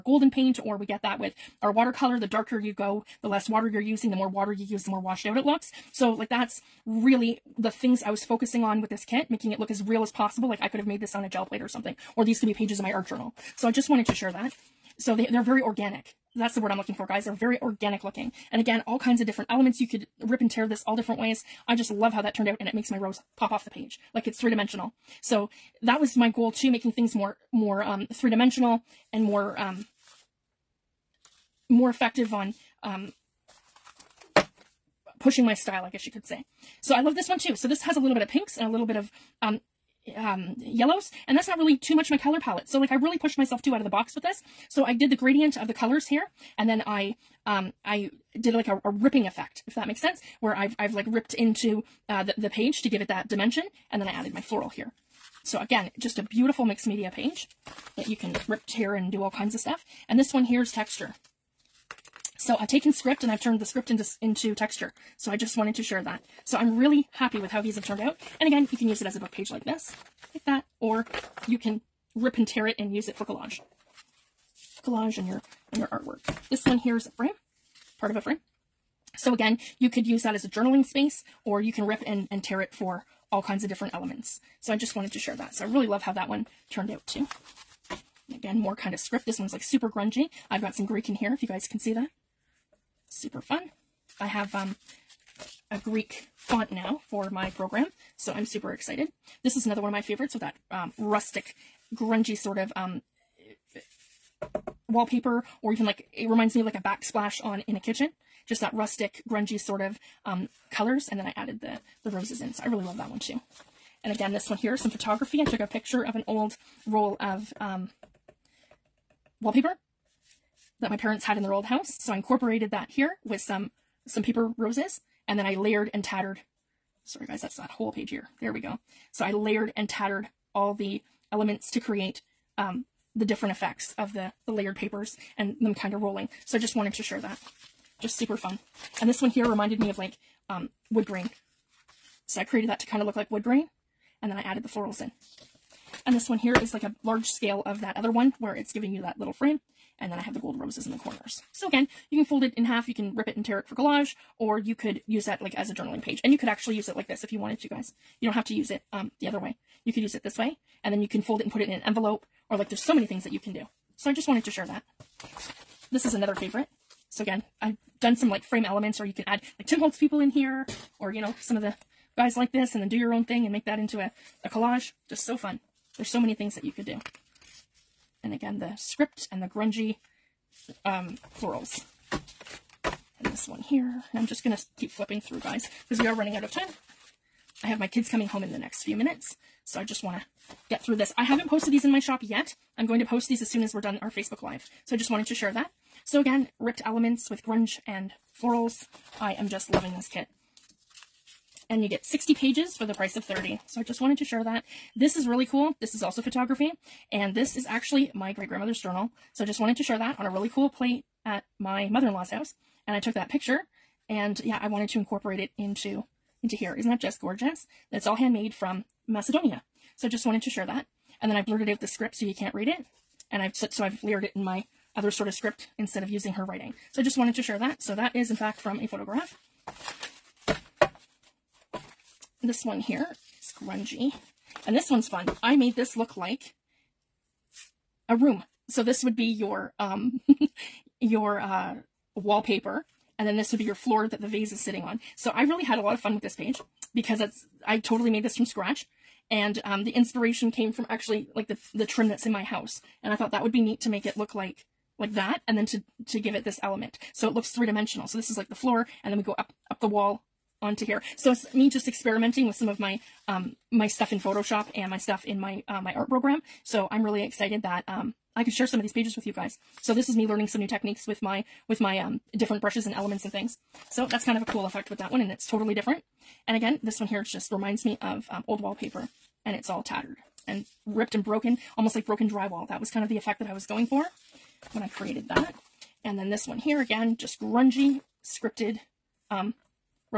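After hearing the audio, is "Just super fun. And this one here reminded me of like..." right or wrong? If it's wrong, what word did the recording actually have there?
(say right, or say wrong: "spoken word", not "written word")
right.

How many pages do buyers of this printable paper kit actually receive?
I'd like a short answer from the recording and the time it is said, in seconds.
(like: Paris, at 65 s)
60, at 202 s.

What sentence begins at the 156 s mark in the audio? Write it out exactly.
And you could actually use it like this if you wanted to, guys.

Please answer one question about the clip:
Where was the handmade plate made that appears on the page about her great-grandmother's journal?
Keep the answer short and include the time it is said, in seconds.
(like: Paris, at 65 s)
Macedonia, at 219 s.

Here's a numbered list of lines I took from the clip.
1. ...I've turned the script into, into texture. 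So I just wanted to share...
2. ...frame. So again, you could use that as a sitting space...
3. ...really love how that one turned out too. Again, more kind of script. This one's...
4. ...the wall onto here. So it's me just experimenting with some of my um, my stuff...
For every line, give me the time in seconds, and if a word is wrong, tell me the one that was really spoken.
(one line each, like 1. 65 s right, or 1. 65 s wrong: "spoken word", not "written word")
1. 63 s right
2. 78 s wrong: "journaling", not "sitting"
3. 85 s right
4. 259 s right.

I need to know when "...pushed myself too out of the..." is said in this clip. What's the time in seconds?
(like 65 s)
43 s.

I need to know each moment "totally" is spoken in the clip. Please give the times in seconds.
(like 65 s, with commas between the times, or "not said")
247 s, 275 s.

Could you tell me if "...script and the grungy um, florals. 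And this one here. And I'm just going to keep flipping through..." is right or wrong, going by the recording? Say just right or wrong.
right.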